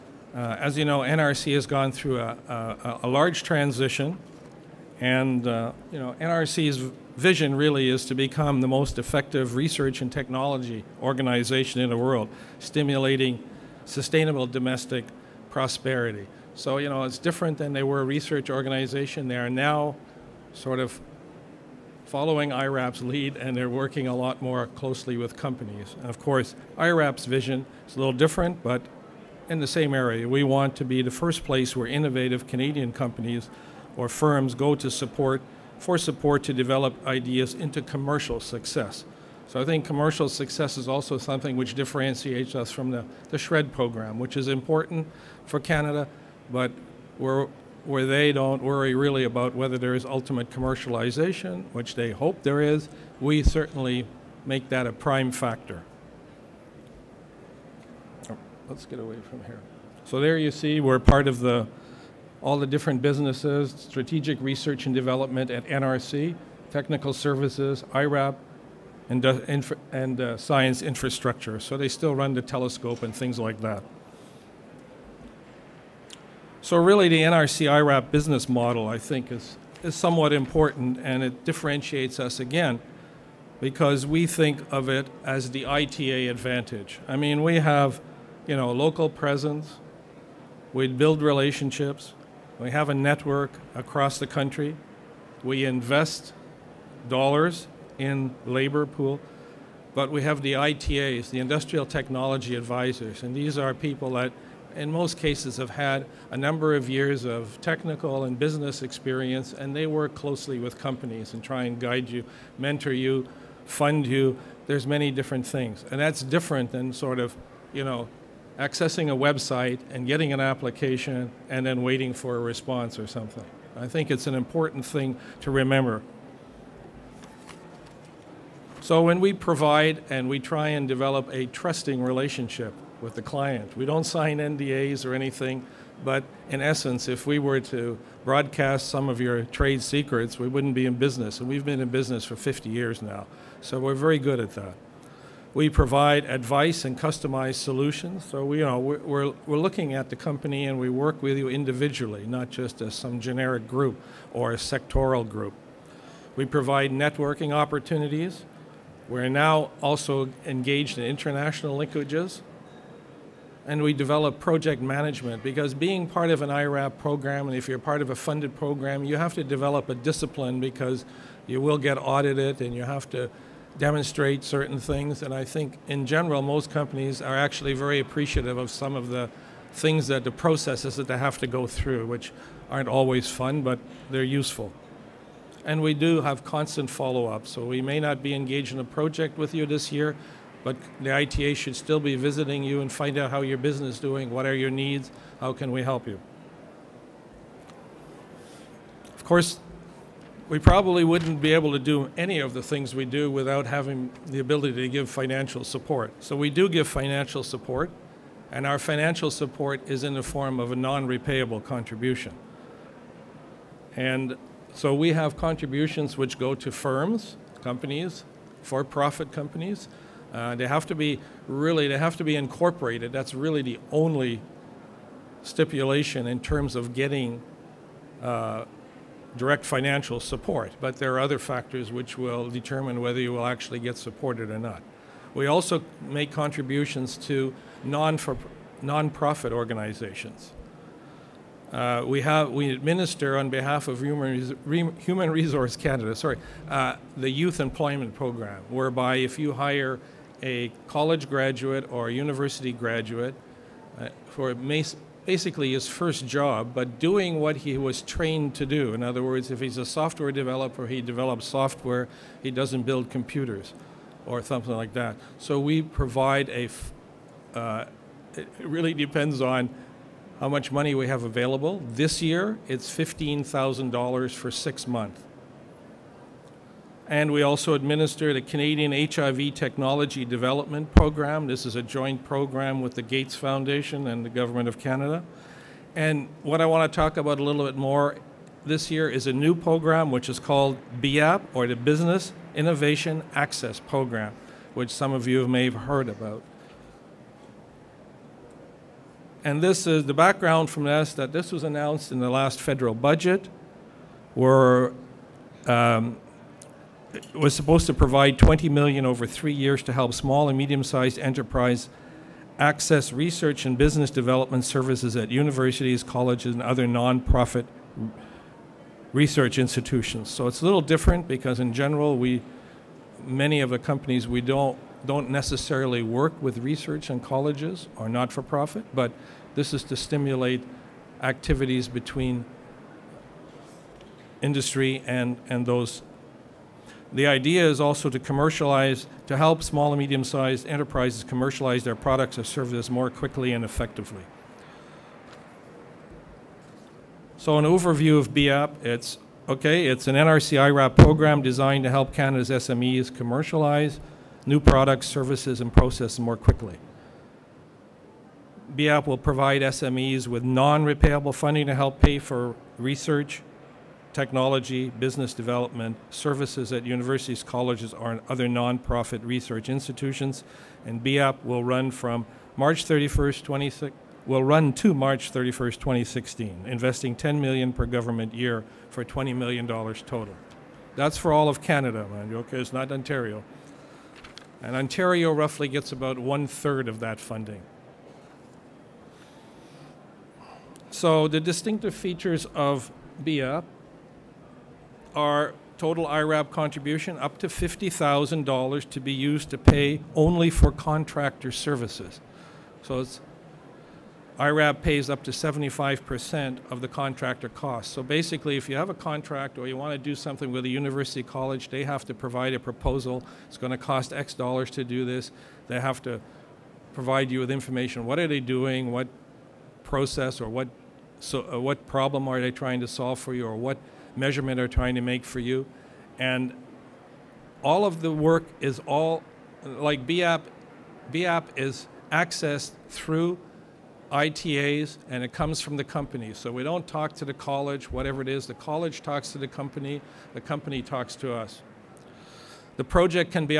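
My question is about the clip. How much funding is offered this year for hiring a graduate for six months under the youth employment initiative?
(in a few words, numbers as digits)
$15,000.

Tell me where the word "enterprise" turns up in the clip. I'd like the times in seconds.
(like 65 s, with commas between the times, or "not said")
311 s, 340 s.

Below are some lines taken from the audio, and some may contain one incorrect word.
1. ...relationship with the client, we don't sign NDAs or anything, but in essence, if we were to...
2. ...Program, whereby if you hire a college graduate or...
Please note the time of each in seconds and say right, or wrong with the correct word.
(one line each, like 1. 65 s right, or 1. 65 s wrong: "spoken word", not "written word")
1. 132 s right
2. 248 s right.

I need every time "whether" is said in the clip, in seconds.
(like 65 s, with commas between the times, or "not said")
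49 s, 232 s.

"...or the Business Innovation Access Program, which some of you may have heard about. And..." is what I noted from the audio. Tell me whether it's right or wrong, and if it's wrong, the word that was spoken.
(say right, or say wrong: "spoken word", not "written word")
right.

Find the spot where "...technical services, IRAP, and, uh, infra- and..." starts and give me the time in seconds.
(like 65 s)
66 s.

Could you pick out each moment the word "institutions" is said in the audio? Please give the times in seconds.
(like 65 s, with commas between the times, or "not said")
319 s, 369 s.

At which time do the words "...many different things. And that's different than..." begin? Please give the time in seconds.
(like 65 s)
114 s.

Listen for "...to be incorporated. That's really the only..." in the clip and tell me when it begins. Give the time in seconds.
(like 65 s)
222 s.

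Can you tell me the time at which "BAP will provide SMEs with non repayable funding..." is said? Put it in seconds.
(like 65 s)
358 s.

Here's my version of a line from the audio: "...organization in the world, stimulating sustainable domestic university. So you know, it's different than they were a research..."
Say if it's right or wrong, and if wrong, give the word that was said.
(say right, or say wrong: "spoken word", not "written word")
wrong: "prosperity", not "university".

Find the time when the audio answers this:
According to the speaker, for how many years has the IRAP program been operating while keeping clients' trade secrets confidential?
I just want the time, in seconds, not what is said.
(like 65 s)
142 s.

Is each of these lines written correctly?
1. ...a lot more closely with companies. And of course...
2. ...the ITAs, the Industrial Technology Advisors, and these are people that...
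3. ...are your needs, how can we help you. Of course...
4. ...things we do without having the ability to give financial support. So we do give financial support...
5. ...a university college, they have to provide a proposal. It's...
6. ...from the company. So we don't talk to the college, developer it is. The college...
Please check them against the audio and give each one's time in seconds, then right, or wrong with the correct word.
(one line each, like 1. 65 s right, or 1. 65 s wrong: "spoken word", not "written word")
1. 24 s right
2. 100 s right
3. 194 s right
4. 202 s right
5. 410 s right
6. 435 s wrong: "whatever", not "developer".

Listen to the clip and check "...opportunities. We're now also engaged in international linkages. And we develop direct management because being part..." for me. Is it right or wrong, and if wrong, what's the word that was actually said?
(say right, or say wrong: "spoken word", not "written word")
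wrong: "project", not "direct".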